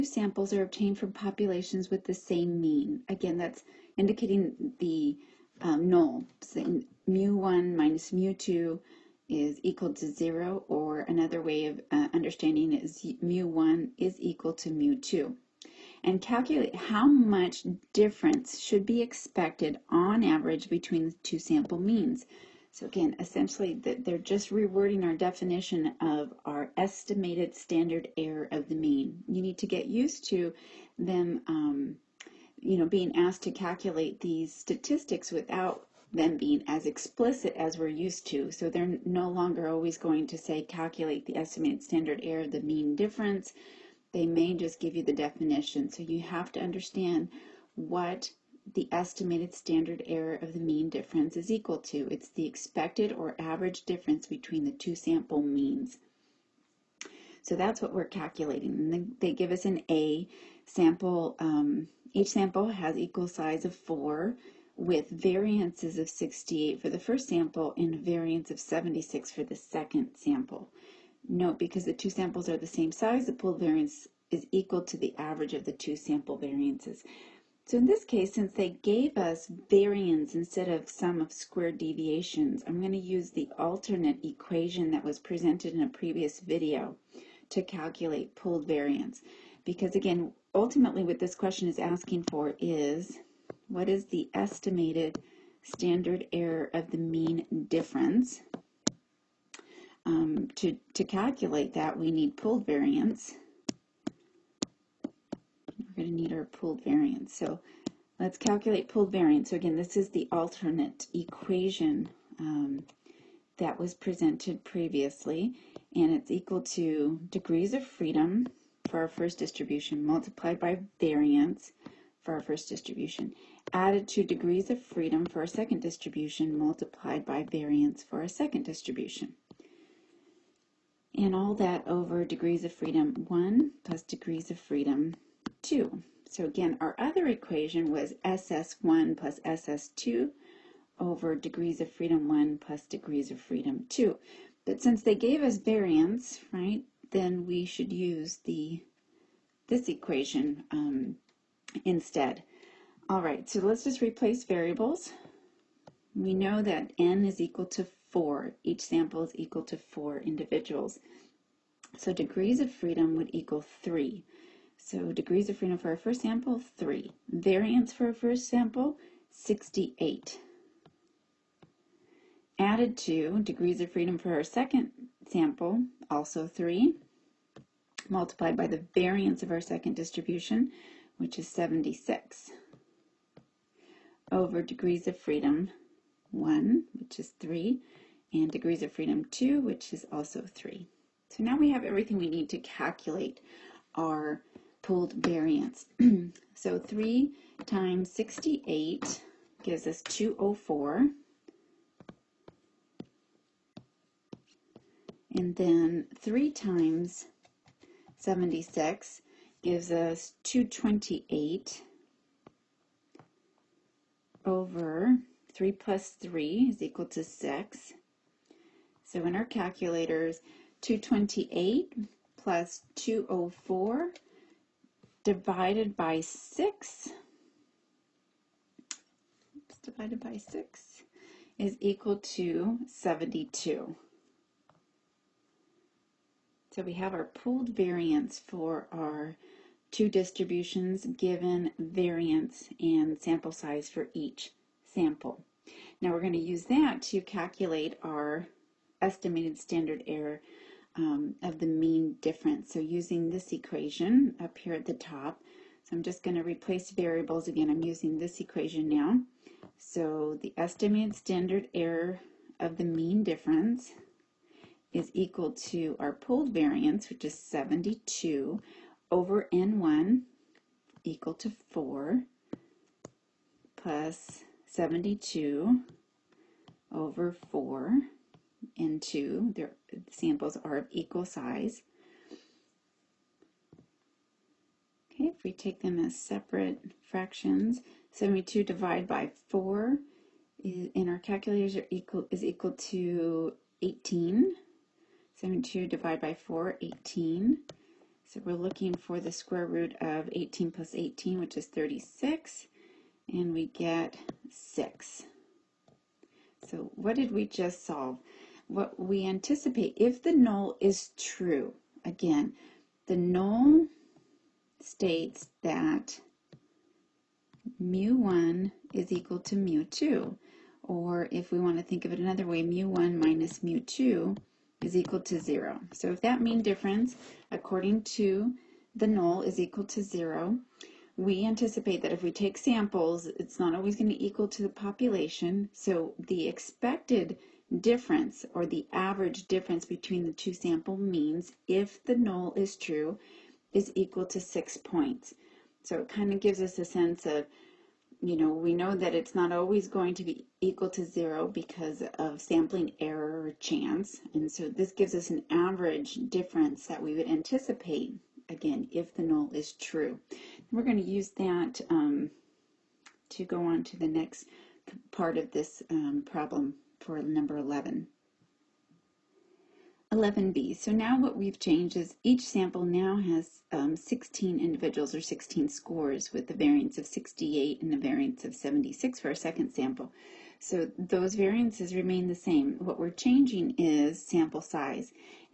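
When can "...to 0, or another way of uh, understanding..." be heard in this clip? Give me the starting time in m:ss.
0:09.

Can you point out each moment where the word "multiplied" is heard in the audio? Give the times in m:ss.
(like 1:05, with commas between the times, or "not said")
2:00, 2:06, 2:58.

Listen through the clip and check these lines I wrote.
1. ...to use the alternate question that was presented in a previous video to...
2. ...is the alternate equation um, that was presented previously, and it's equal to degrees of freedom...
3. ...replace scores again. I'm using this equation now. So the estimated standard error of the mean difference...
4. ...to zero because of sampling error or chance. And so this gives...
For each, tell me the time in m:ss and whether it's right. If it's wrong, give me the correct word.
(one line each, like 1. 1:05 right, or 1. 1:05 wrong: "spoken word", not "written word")
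1. 1:22 wrong: "equation", not "question"
2. 1:49 right
3. 4:16 wrong: "variables", not "scores"
4. 5:50 right.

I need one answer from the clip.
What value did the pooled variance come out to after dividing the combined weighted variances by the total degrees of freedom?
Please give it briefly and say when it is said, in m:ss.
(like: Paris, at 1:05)
72, at 3:51.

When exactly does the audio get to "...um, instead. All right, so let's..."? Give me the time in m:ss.
2:30.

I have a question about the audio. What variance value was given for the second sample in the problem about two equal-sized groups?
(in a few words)
76.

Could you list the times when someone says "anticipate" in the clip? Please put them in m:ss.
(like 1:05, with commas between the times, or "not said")
5:09, 5:31, 5:57.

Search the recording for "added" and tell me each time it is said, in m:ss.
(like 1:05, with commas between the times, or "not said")
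2:03, 2:52.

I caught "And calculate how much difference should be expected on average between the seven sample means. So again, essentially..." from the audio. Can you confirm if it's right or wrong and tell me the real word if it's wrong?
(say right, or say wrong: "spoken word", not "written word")
wrong: "two", not "seven".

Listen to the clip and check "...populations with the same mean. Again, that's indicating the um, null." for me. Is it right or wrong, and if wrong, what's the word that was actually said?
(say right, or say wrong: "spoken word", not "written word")
right.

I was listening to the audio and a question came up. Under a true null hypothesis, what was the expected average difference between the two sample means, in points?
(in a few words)
6.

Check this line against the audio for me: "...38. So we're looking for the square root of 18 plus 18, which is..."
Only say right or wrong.
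wrong.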